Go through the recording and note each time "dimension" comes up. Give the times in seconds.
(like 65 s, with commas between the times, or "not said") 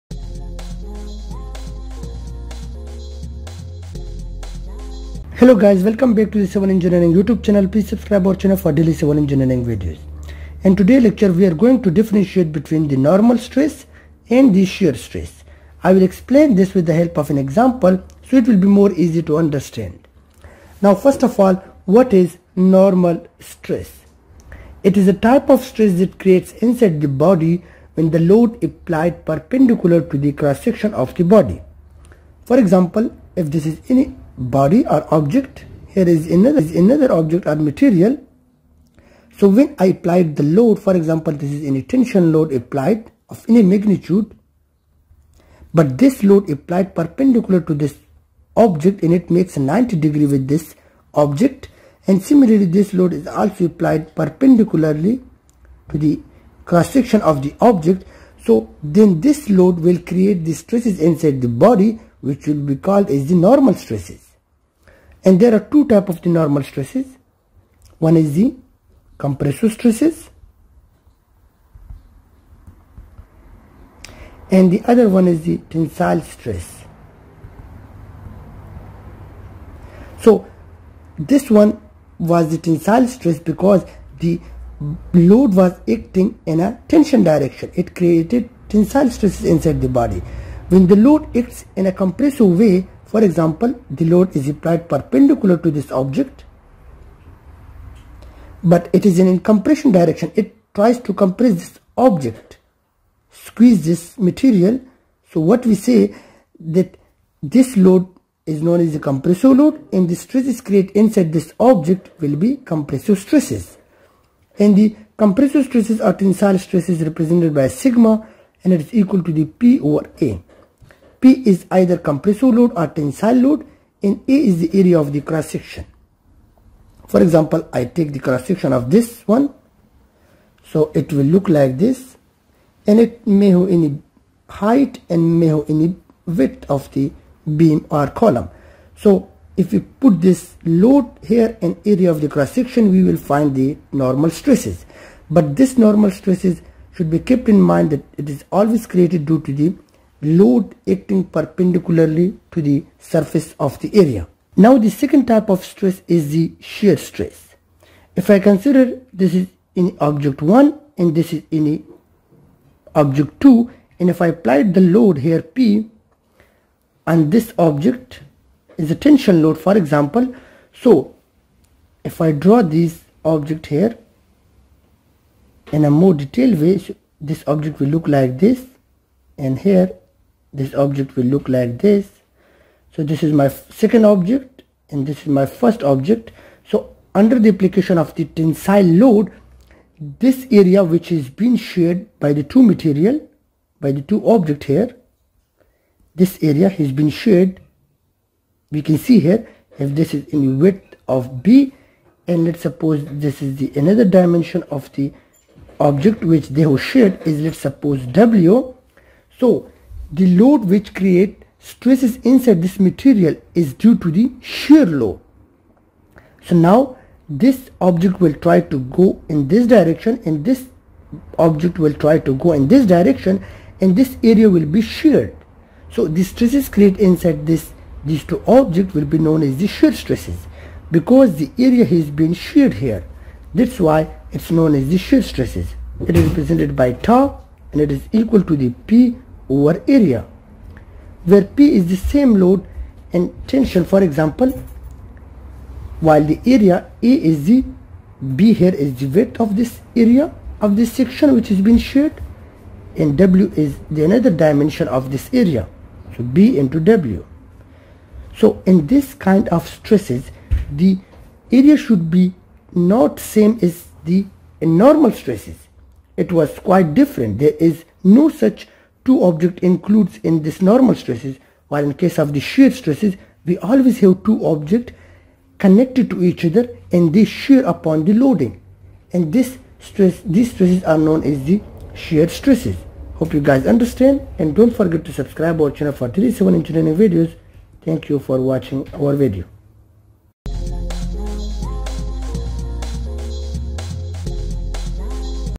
204 s, 254 s.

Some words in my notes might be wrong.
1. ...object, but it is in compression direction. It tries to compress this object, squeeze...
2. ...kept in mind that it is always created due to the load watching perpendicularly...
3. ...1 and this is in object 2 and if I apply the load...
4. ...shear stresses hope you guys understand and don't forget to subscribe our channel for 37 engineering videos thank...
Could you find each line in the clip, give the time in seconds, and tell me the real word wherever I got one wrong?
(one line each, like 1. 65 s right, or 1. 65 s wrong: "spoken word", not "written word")
1. 95 s right
2. 147 s wrong: "acting", not "watching"
3. 160 s right
4. 281 s right.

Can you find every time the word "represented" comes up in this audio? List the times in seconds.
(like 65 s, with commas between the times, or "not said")
117 s, 236 s.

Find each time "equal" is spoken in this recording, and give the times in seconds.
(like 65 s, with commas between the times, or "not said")
118 s, 238 s.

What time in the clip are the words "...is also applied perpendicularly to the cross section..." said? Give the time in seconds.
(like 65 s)
53 s.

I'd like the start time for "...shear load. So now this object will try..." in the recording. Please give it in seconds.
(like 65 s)
214 s.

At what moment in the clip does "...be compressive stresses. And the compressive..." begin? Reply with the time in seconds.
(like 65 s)
112 s.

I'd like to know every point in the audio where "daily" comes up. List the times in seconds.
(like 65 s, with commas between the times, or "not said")
8 s.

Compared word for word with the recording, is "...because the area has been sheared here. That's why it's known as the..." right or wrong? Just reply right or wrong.
right.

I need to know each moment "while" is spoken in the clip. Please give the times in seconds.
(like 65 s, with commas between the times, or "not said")
245 s, 271 s.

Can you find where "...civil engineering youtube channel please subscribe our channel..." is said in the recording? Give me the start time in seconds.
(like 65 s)
6 s.